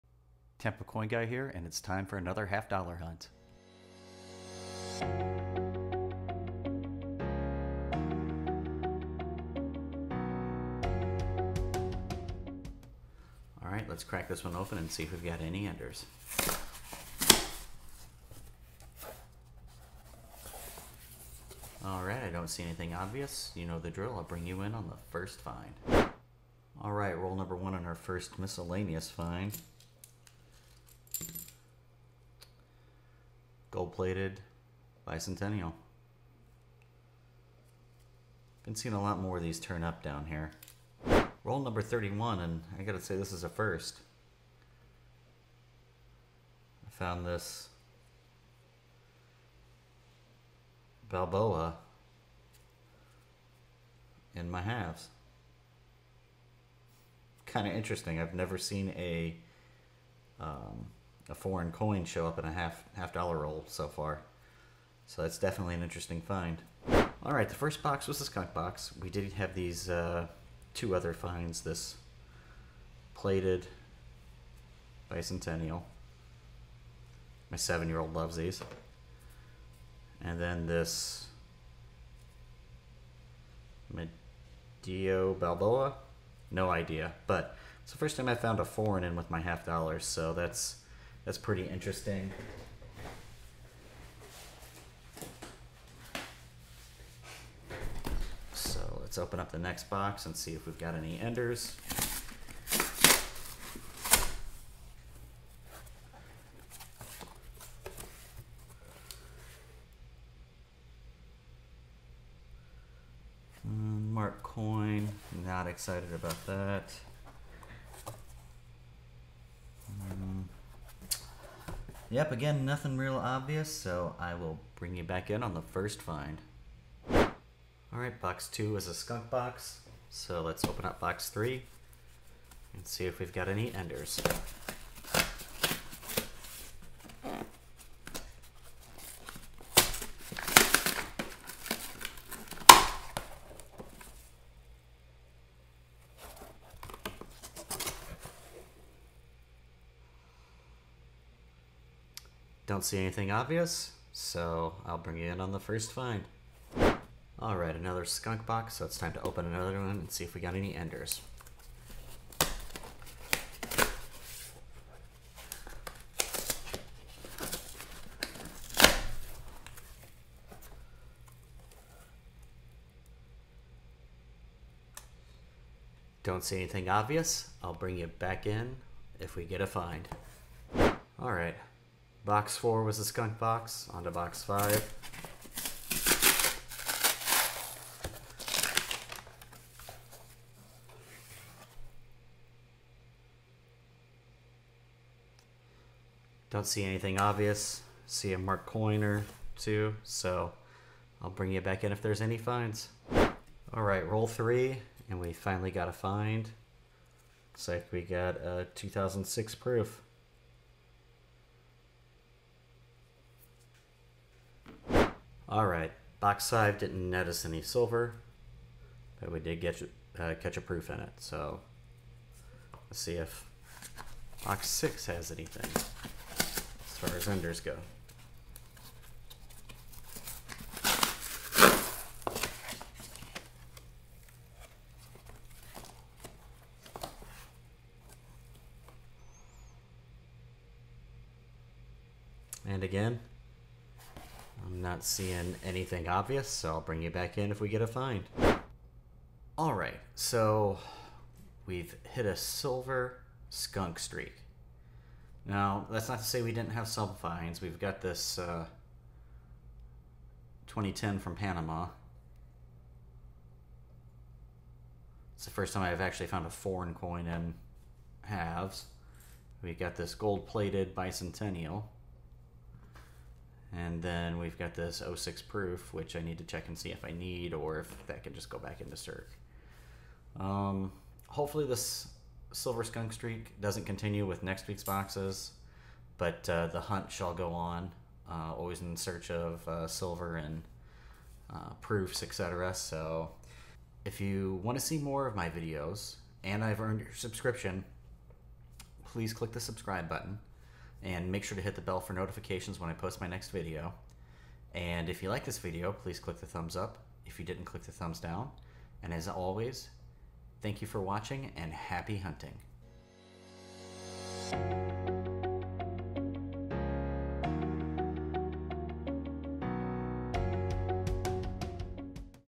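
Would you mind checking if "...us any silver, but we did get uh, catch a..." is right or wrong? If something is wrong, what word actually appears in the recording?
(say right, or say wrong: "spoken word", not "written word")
right.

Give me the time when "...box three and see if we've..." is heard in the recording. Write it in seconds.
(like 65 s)
130 s.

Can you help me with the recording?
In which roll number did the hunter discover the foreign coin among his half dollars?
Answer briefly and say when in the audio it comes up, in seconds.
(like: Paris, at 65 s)
31, at 41 s.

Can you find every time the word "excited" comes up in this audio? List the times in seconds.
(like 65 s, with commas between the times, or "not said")
115 s.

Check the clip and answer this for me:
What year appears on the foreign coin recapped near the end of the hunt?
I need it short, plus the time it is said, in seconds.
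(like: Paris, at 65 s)
2010, at 260 s.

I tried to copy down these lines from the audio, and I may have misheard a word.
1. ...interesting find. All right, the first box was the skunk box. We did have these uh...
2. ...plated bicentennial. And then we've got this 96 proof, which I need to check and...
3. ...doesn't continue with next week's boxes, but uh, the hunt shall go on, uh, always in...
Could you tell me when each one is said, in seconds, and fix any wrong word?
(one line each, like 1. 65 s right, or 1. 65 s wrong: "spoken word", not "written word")
1. 65 s right
2. 270 s wrong: "06", not "96"
3. 283 s right.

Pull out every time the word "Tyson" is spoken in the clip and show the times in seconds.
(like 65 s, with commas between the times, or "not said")
not said.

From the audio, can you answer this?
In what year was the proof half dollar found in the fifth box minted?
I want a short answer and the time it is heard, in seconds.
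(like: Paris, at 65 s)
2006, at 208 s.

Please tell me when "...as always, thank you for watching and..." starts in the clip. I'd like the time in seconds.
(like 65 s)
309 s.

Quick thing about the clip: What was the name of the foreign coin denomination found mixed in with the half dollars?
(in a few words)
Medio Balboa.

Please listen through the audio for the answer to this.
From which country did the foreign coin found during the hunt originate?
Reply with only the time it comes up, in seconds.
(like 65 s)
261 s.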